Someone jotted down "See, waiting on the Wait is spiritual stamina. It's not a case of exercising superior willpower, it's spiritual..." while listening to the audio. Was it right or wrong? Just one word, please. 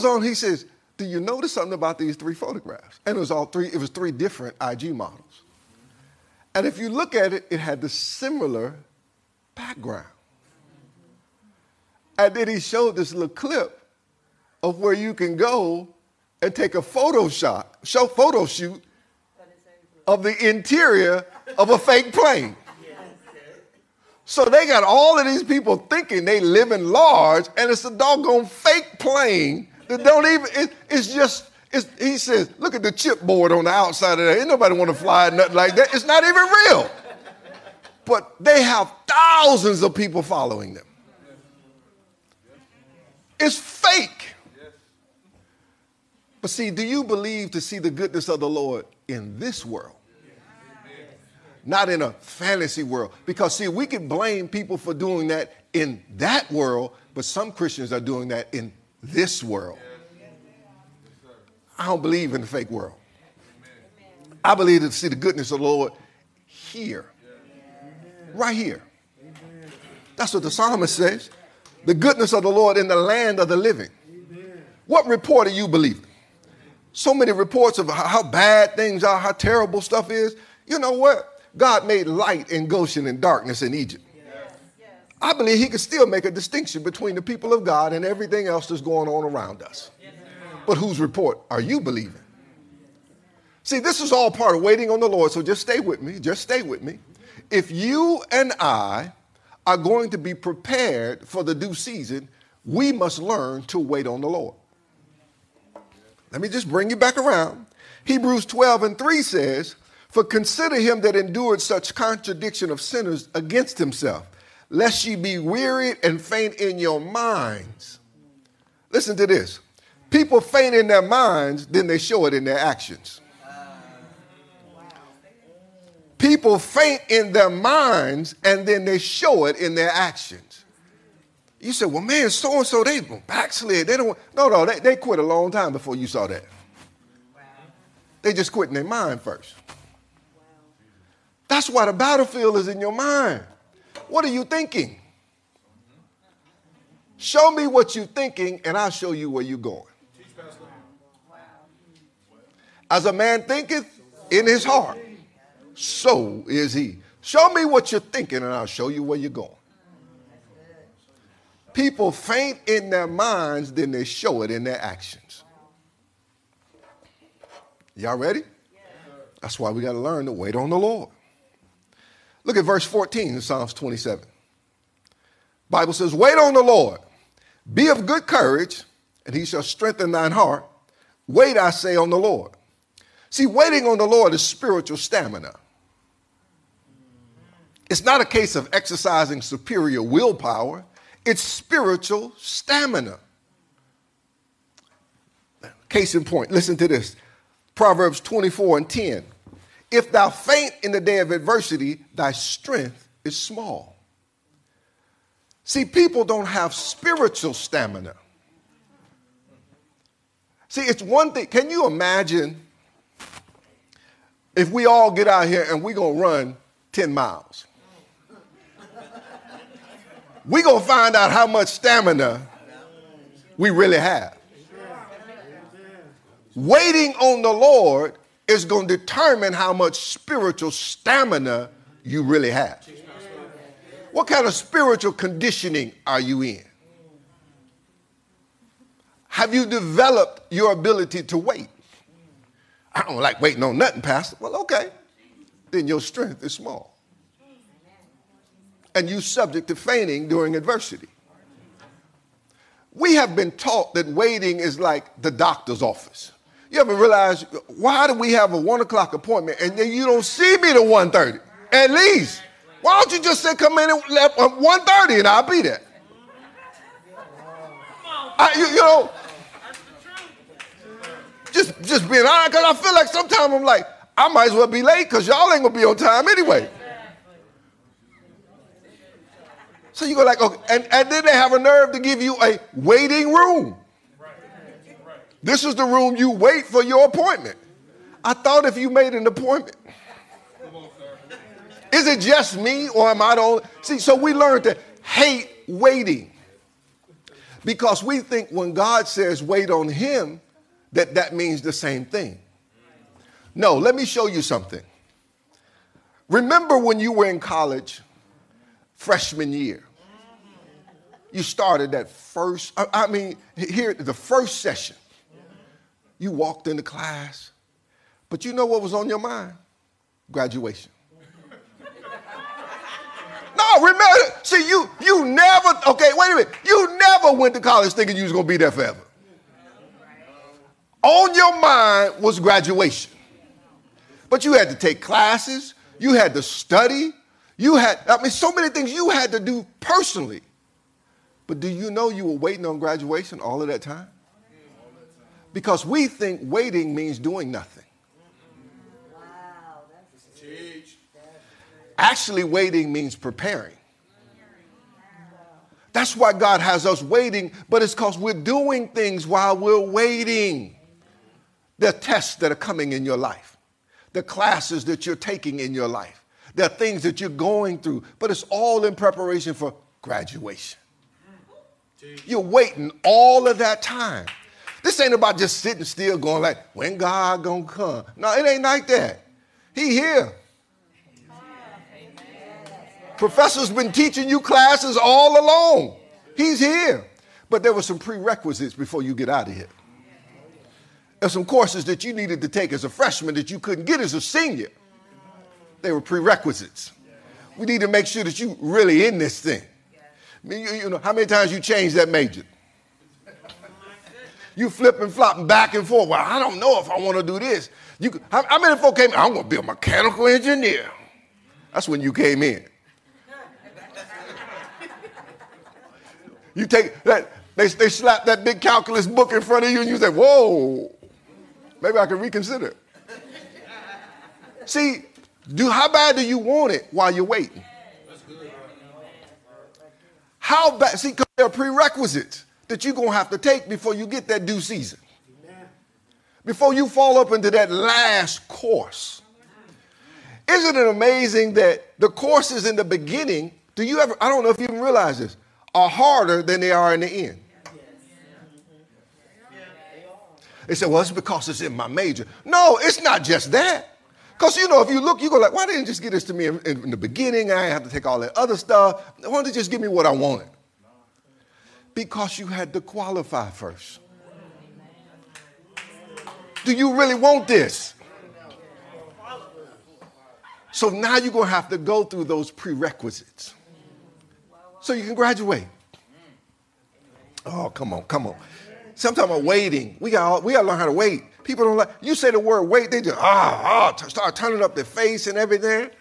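wrong.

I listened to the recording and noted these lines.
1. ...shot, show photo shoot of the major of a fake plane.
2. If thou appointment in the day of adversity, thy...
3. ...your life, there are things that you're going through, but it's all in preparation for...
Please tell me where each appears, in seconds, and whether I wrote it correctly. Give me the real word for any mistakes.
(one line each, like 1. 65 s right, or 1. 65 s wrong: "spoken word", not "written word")
1. 17 s wrong: "interior", not "major"
2. 199 s wrong: "faint", not "appointment"
3. 365 s right.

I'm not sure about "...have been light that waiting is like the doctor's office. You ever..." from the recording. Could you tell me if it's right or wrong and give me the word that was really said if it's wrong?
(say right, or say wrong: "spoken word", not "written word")
wrong: "taught", not "light".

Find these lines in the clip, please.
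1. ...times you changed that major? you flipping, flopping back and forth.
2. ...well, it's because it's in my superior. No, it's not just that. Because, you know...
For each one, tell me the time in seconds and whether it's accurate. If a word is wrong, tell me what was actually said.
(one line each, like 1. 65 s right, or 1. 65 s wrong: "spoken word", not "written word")
1. 401 s right
2. 450 s wrong: "major", not "superior".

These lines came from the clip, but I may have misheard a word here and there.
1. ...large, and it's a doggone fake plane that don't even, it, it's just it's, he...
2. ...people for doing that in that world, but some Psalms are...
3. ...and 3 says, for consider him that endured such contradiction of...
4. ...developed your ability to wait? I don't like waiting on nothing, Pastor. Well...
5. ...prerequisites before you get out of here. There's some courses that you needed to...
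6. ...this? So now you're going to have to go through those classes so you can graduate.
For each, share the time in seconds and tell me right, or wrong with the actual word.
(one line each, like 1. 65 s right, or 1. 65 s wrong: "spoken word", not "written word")
1. 26 s right
2. 54 s wrong: "Christians", not "Psalms"
3. 108 s right
4. 239 s right
5. 387 s right
6. 467 s wrong: "prerequisites", not "classes".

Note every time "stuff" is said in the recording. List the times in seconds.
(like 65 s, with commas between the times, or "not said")
79 s, 458 s.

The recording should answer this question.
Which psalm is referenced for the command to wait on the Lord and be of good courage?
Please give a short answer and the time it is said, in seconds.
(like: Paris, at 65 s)
Psalms 27, at 173 s.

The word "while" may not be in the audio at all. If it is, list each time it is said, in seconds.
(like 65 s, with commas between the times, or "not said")
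359 s, 426 s.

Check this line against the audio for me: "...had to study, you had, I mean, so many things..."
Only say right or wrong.
right.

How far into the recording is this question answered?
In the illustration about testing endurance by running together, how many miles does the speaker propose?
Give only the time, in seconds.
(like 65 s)
216 s.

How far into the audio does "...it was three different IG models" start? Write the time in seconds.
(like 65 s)
3 s.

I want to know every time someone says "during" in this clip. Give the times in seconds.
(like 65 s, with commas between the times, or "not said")
250 s.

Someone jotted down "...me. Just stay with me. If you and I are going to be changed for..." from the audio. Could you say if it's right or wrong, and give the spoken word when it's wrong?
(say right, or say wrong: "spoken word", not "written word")
wrong: "prepared", not "changed".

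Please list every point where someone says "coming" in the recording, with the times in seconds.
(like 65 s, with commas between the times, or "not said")
362 s.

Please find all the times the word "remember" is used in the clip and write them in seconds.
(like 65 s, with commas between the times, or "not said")
306 s, 323 s.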